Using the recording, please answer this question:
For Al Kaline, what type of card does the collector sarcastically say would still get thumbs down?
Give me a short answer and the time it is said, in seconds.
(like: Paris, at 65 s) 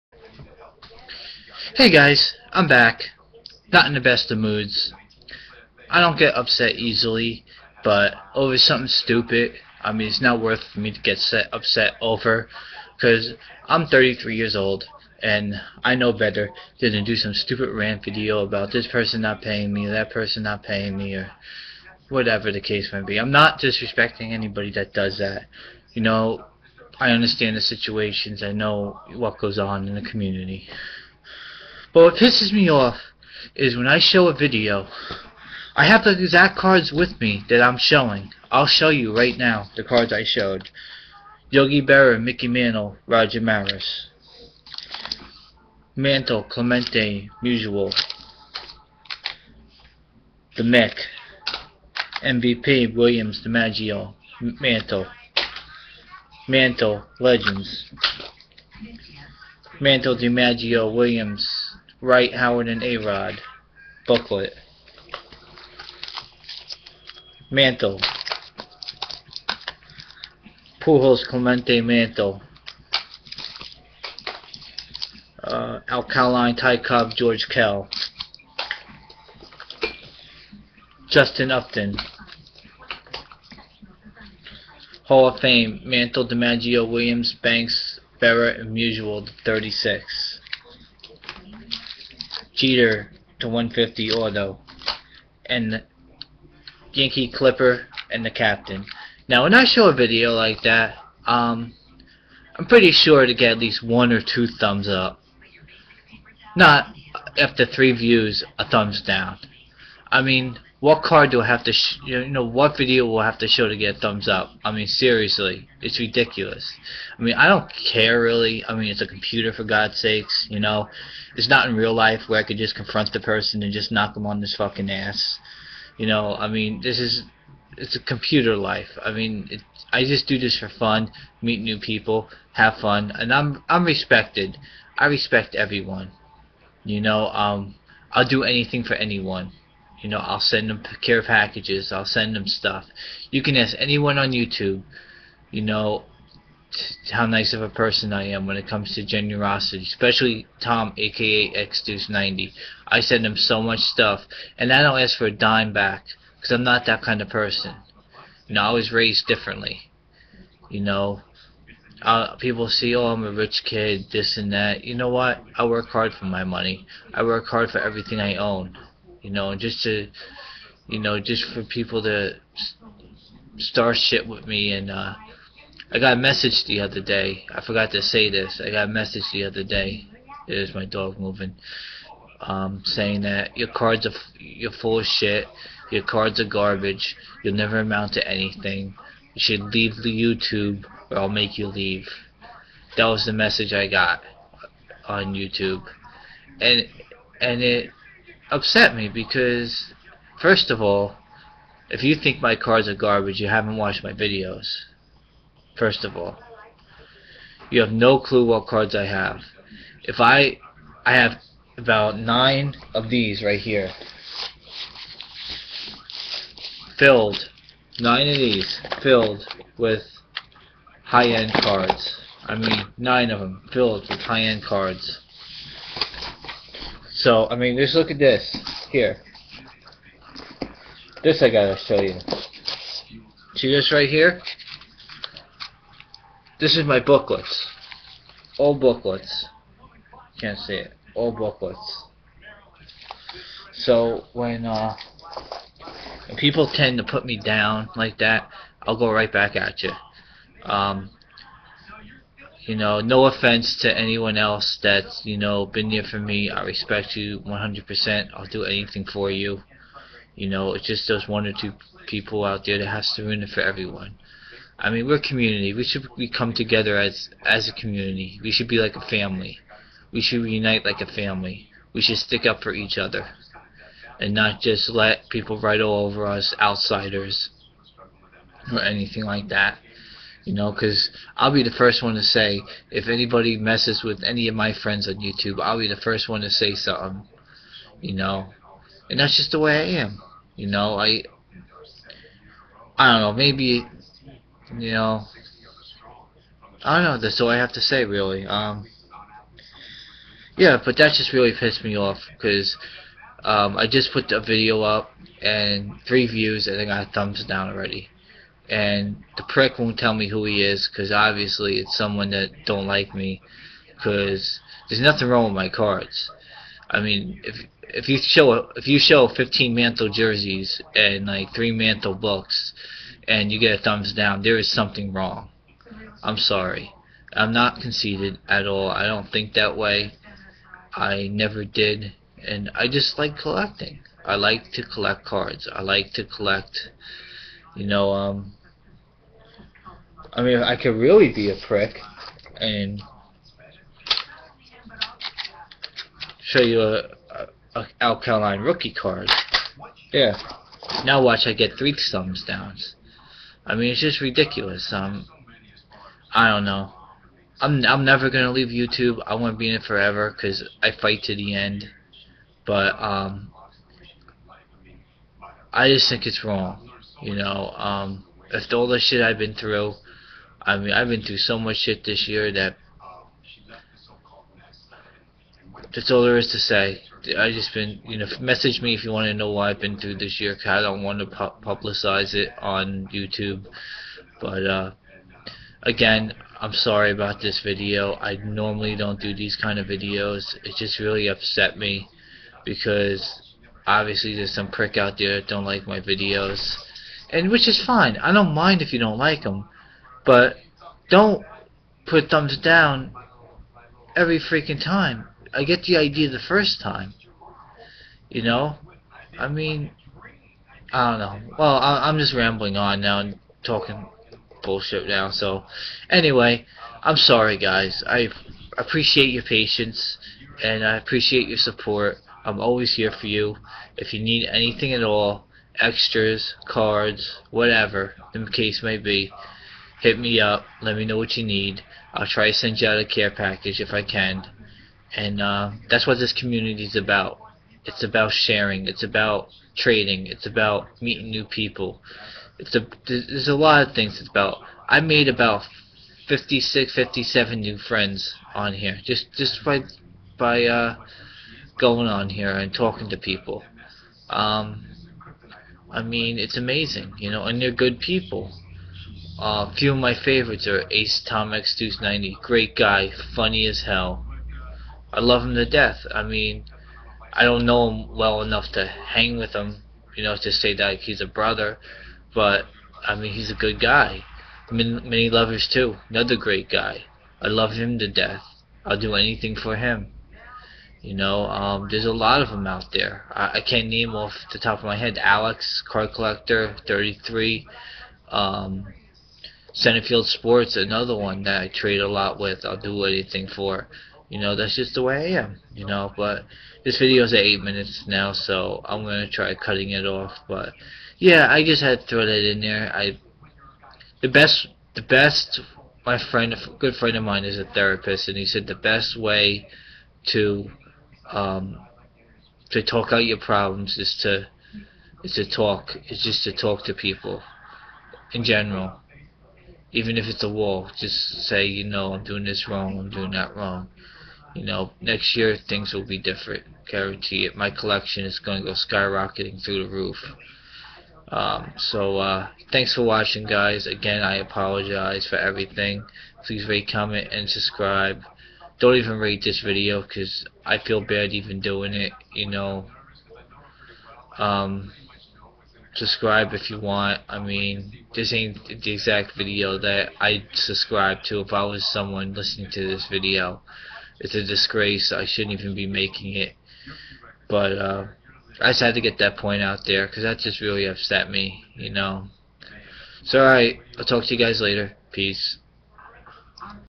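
rookie card, at 348 s.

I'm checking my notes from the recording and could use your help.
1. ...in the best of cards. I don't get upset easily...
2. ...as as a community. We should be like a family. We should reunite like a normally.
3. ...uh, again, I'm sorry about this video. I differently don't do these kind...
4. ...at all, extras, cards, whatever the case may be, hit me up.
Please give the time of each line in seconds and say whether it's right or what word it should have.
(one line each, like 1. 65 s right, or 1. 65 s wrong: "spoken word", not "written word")
1. 3 s wrong: "moods", not "cards"
2. 266 s wrong: "family", not "normally"
3. 384 s wrong: "normally", not "differently"
4. 424 s right.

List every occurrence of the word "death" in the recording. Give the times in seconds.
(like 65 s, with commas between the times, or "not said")
465 s, 478 s.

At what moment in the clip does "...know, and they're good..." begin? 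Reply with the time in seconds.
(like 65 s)
457 s.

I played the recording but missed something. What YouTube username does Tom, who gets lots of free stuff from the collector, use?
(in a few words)
XDeuce90.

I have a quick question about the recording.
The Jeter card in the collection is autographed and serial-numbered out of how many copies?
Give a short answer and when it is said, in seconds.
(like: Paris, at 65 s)
150, at 93 s.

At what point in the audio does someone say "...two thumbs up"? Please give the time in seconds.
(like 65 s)
104 s.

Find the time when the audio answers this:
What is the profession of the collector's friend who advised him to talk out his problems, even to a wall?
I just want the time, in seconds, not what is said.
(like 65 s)
507 s.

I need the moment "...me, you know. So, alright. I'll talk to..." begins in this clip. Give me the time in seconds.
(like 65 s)
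561 s.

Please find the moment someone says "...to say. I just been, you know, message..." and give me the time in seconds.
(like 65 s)
376 s.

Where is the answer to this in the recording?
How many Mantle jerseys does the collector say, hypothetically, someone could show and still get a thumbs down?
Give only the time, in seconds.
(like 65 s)
319 s.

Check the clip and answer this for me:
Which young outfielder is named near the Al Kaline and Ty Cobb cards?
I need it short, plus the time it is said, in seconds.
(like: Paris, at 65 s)
Justin Upton, at 81 s.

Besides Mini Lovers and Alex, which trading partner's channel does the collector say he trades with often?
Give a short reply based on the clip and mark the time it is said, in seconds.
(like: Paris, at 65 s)
Centerfield Sports, at 489 s.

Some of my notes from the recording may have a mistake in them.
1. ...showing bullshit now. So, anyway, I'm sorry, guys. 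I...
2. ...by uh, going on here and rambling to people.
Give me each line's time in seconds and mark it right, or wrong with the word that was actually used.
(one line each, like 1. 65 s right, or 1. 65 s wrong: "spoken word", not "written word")
1. 413 s wrong: "talking", not "showing"
2. 450 s wrong: "talking", not "rambling".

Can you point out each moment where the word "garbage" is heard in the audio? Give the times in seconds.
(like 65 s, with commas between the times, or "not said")
186 s, 202 s.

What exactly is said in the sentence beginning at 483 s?
I, I can't name off the top of my head.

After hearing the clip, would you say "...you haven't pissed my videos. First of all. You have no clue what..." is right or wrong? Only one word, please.
wrong.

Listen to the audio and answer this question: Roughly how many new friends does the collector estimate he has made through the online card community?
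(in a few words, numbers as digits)
56 or 57.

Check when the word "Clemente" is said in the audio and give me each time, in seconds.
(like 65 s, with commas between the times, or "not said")
46 s, 71 s.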